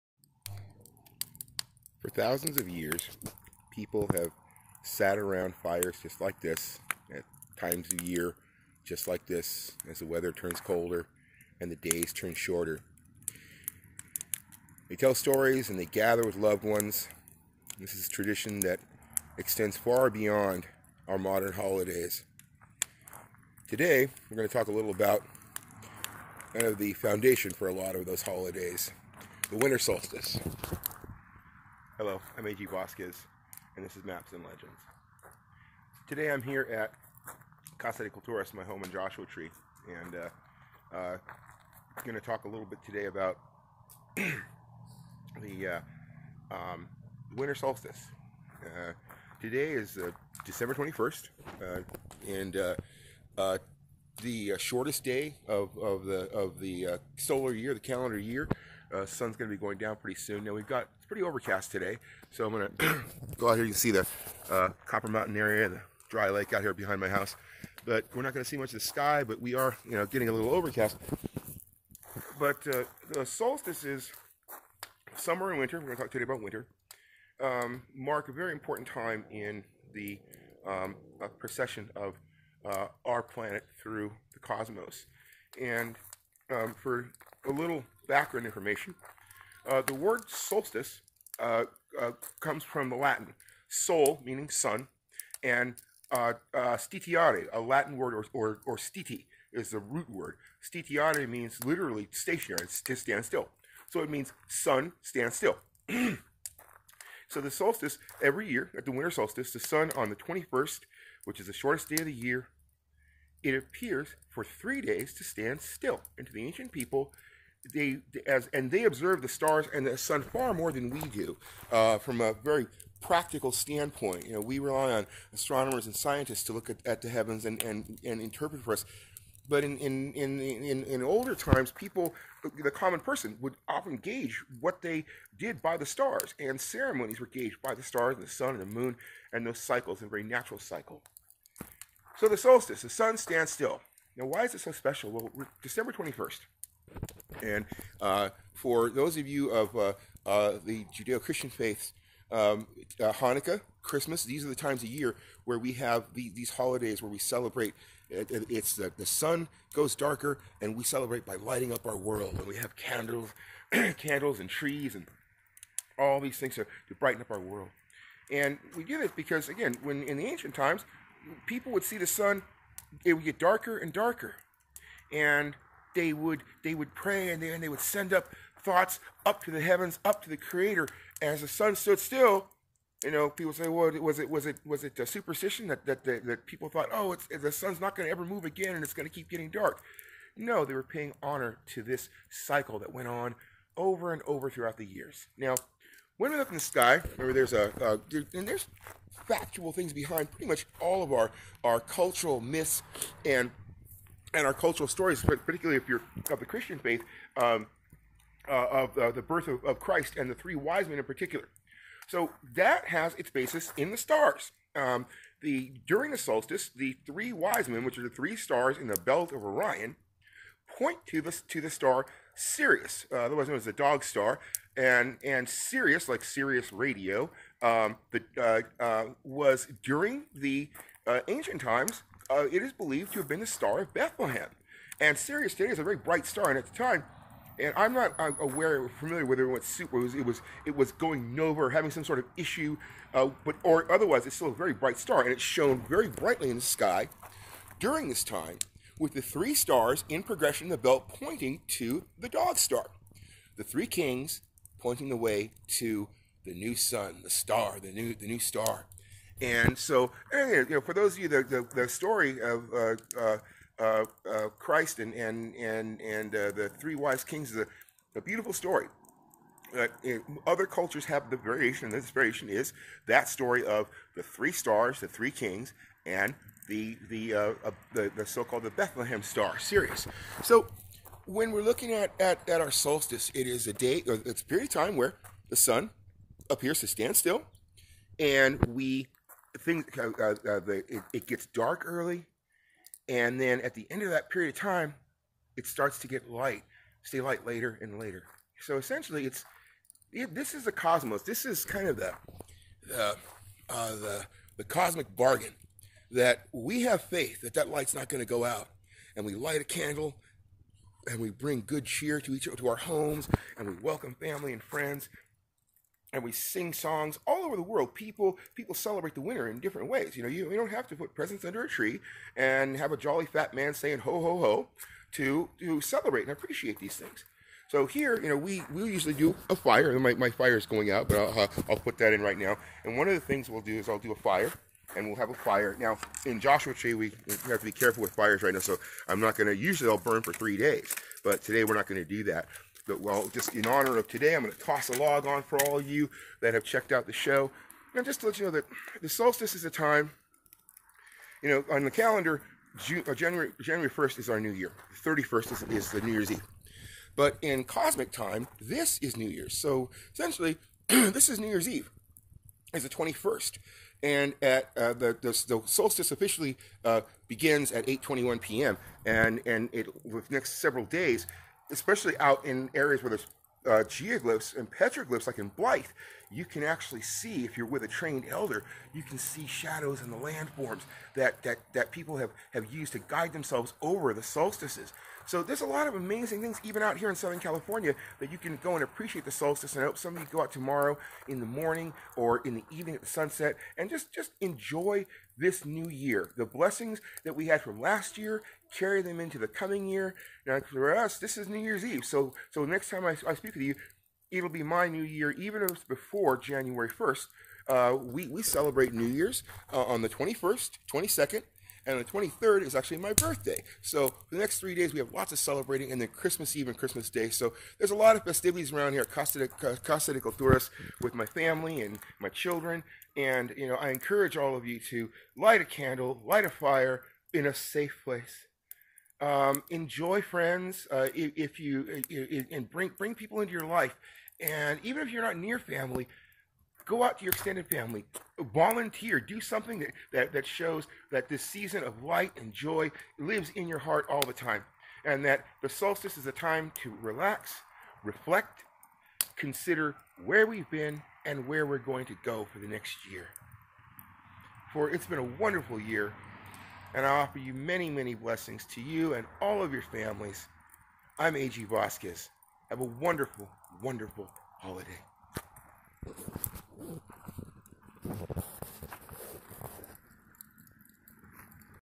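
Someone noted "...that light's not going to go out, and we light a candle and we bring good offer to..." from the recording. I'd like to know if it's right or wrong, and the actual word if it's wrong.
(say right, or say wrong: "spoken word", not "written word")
wrong: "cheer", not "offer".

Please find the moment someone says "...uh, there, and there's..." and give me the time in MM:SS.
03:17.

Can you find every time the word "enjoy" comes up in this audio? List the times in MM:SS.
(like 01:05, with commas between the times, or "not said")
06:34, 07:09.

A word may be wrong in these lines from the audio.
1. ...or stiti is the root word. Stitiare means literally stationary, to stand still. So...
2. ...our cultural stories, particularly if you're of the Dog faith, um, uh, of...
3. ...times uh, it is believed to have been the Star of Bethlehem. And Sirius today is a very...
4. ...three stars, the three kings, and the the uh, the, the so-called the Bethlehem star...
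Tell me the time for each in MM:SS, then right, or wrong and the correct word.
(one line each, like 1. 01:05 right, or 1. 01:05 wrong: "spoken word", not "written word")
1. 01:38 right
2. 03:24 wrong: "Christian", not "Dog"
3. 03:51 right
4. 04:34 right.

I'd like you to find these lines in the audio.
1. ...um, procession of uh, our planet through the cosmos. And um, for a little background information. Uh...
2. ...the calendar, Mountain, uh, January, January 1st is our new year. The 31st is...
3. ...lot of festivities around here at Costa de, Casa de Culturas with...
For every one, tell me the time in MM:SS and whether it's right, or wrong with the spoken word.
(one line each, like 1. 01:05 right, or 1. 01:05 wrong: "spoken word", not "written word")
1. 01:20 right
2. 05:51 wrong: "June", not "Mountain"
3. 06:57 right.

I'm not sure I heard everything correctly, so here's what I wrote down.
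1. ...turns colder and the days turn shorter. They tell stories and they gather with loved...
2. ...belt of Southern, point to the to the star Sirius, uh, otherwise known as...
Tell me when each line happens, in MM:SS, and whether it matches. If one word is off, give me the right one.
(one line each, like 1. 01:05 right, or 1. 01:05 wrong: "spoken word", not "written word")
1. 00:10 right
2. 03:39 wrong: "Orion", not "Southern".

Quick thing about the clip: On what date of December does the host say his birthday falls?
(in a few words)
23rd.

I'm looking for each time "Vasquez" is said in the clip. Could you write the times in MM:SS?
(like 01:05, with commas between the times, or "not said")
00:32, 07:41.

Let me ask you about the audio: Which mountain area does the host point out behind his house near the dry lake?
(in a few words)
Copper Mountain.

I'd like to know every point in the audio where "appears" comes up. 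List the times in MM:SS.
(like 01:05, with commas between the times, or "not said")
01:53, 04:46.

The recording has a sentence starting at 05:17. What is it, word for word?
People people celebrate the winter in different ways.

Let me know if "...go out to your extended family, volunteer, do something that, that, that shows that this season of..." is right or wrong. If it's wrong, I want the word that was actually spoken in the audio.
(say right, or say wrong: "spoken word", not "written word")
right.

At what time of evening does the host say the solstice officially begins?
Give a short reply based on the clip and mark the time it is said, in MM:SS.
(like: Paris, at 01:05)
8:21 p.m., at 06:07.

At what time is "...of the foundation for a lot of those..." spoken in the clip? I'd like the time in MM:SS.
00:26.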